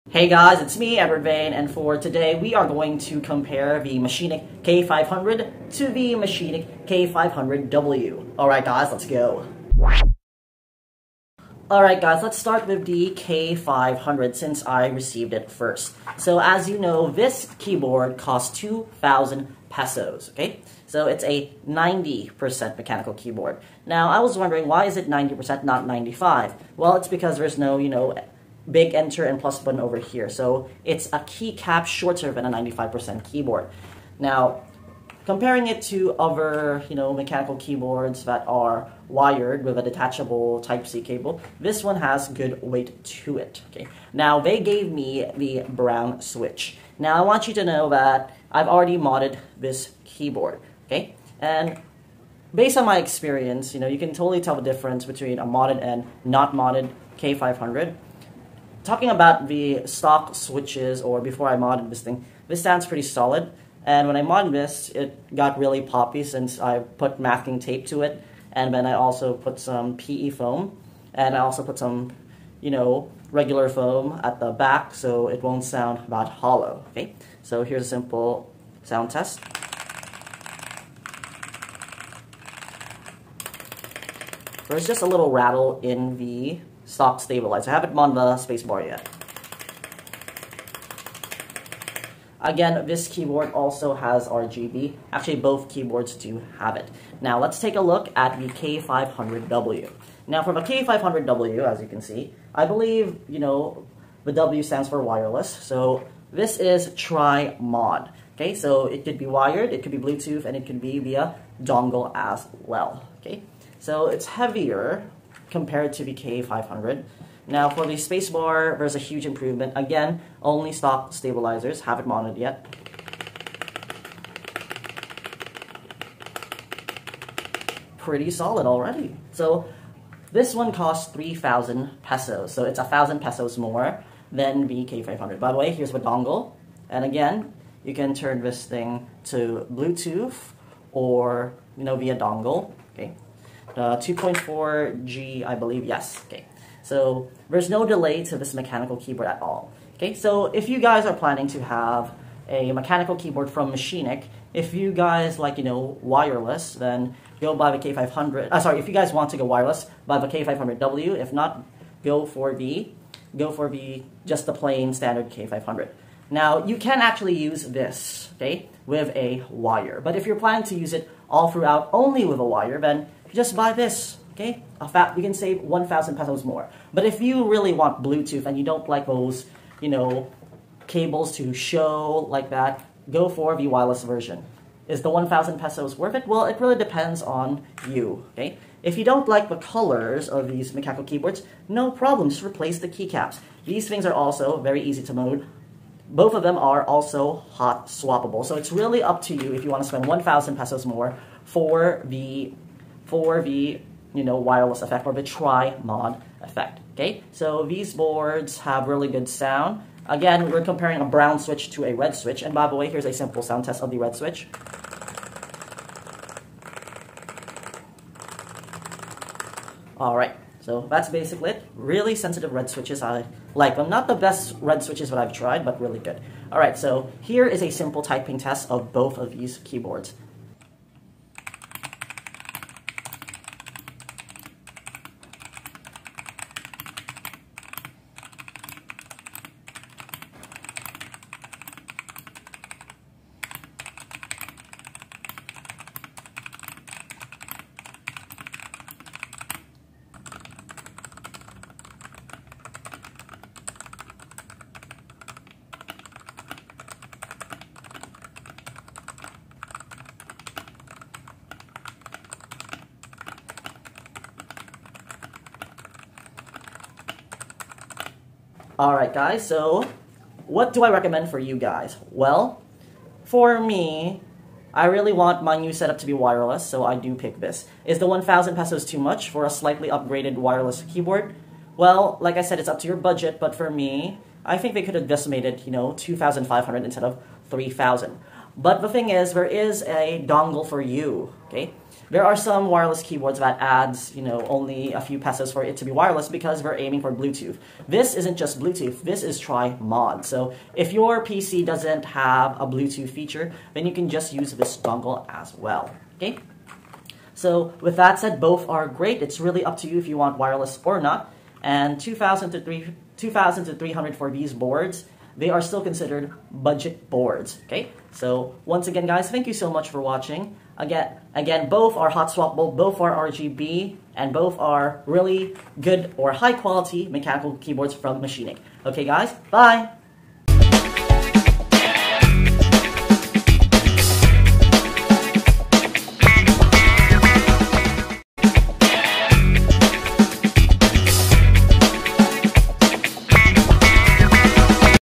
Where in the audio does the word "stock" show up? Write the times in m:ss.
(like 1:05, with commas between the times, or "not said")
0:59, 2:00.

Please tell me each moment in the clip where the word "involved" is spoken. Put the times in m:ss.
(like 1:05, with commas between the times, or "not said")
not said.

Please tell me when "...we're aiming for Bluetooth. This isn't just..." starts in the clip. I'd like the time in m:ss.
4:56.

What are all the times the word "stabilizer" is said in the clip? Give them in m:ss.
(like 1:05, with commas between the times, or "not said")
1:27, 2:01.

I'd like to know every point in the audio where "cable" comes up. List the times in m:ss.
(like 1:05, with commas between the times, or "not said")
0:41, 3:00.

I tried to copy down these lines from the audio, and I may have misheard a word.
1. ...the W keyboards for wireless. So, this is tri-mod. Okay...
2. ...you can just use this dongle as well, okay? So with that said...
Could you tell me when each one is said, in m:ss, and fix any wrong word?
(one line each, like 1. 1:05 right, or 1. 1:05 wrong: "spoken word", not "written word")
1. 1:44 wrong: "stands", not "keyboards"
2. 5:03 right.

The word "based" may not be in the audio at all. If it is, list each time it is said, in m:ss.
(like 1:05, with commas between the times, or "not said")
0:52.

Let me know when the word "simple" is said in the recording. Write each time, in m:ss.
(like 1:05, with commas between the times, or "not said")
1:17, 3:33, 3:47.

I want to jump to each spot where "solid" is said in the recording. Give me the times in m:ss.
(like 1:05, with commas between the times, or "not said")
1:03, 2:08.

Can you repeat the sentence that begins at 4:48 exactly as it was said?
But the thing is, there is a dongle for you, okay?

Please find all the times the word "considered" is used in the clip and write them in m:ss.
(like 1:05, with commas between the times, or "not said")
5:15.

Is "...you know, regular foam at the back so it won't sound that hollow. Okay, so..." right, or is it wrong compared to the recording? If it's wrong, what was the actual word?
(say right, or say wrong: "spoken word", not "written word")
right.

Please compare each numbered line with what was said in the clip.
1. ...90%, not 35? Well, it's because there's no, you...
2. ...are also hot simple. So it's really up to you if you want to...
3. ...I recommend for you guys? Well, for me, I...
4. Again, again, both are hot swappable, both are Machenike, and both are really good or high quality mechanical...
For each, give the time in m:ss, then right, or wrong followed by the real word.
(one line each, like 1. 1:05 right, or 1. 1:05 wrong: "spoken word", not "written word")
1. 0:25 wrong: "95", not "35"
2. 3:16 wrong: "swappable", not "simple"
3. 4:30 right
4. 5:20 wrong: "RGB", not "Machenike".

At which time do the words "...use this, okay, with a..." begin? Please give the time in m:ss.
2:47.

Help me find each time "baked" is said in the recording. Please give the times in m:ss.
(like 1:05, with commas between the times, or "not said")
not said.